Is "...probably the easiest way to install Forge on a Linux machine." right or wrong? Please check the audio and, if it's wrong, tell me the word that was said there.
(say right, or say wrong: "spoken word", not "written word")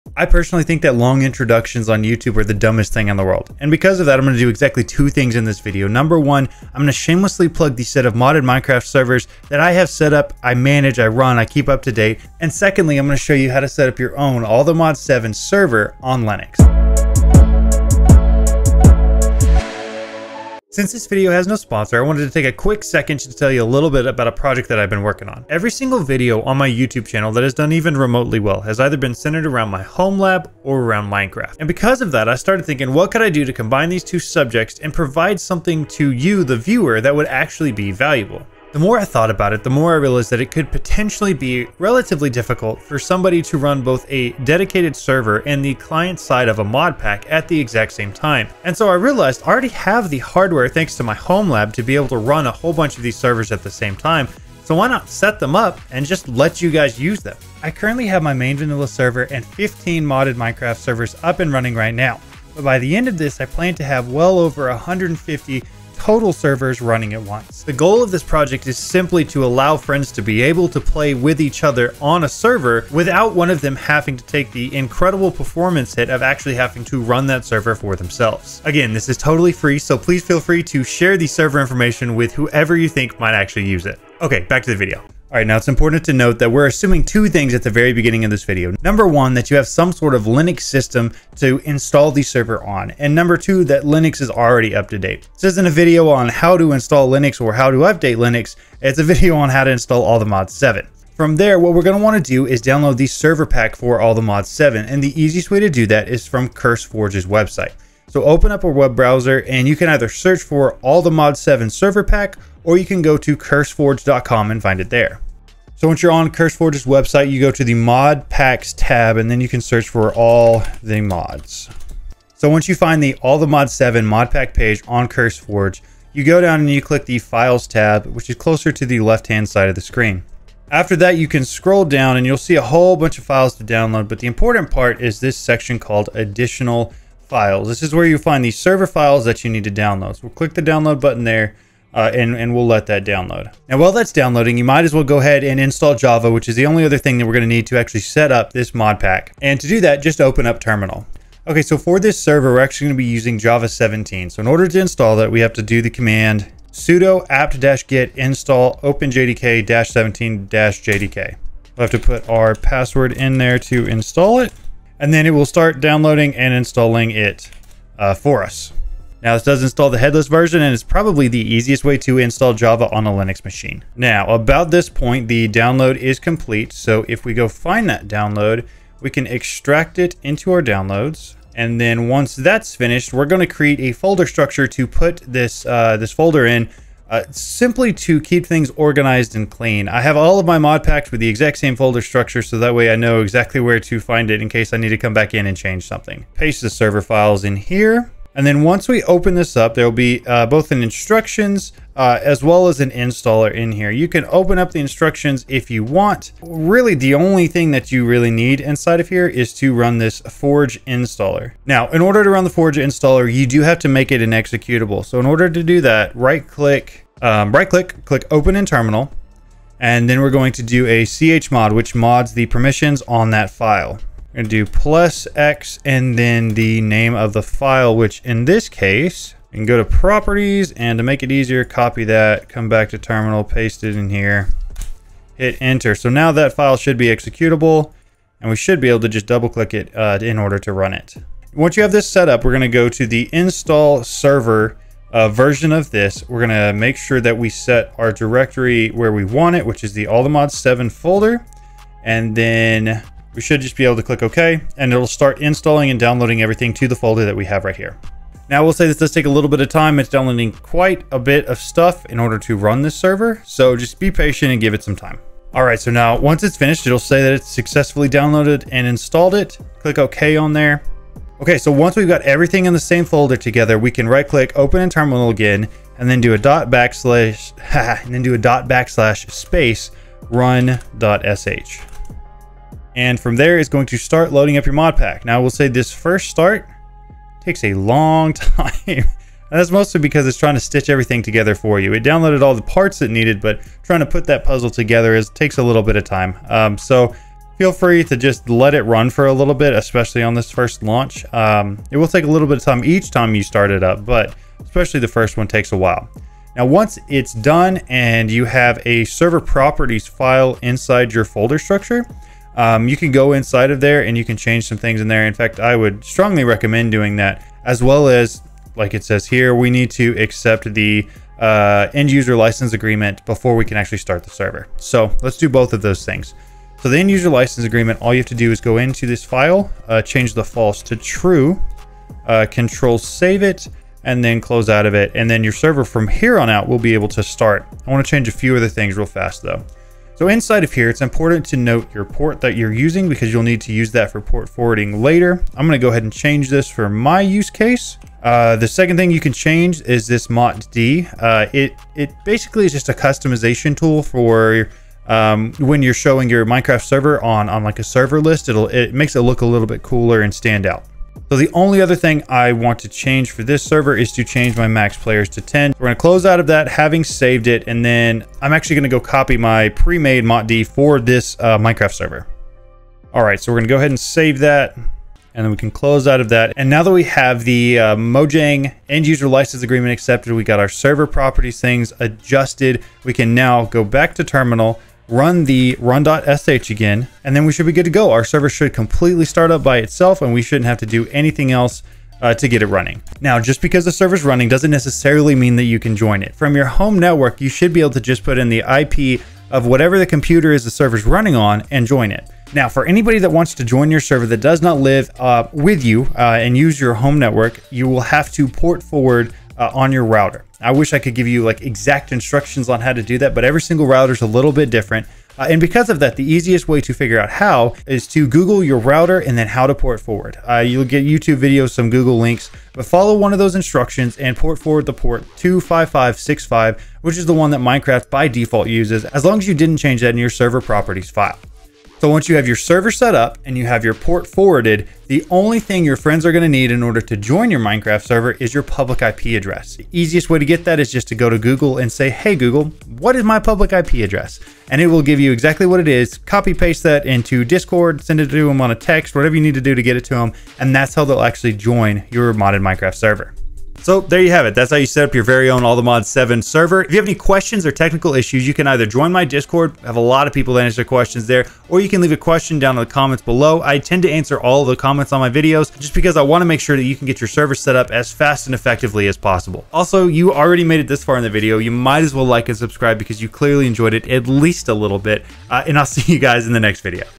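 wrong: "Java", not "Forge".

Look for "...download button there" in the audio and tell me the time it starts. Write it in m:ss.
2:20.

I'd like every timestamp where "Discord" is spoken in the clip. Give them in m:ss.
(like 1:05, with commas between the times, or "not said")
7:27, 7:39.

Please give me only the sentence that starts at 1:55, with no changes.
So once you're on CurseForge's website, you go to the mod packs tab and then you can search for all the mods.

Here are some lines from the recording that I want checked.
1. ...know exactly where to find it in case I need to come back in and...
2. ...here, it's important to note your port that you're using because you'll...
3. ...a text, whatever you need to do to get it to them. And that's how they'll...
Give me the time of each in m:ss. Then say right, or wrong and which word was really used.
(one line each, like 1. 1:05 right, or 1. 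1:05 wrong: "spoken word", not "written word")
1. 3:12 right
2. 5:40 right
3. 7:28 right.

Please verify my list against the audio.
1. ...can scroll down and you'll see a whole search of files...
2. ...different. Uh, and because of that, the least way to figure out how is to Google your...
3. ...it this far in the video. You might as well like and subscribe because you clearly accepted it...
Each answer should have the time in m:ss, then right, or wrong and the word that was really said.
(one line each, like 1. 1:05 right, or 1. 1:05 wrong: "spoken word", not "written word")
1. 2:11 wrong: "bunch", not "search"
2. 6:54 wrong: "easiest", not "least"
3. 7:50 wrong: "enjoyed", not "accepted".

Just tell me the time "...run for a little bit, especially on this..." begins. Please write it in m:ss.
4:58.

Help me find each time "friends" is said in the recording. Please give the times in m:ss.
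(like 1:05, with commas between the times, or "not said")
1:09, 7:15.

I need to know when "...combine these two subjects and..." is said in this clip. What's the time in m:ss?
0:33.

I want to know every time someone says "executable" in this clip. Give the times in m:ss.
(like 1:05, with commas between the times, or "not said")
3:34, 3:57.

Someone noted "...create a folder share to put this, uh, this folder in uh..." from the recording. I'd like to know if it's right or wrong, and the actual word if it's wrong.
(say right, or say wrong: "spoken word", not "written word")
wrong: "structure", not "share".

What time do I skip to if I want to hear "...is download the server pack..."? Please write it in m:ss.
1:42.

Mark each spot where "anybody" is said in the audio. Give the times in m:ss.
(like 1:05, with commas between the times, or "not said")
6:42.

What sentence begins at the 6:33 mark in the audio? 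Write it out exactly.
Now, just because the server's running doesn't necessarily mean that you can join it.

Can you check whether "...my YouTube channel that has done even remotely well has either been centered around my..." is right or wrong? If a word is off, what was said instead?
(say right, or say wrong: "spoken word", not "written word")
right.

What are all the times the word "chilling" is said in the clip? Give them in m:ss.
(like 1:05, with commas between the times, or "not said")
not said.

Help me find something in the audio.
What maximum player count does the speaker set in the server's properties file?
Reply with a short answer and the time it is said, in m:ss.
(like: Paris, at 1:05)
10, at 6:05.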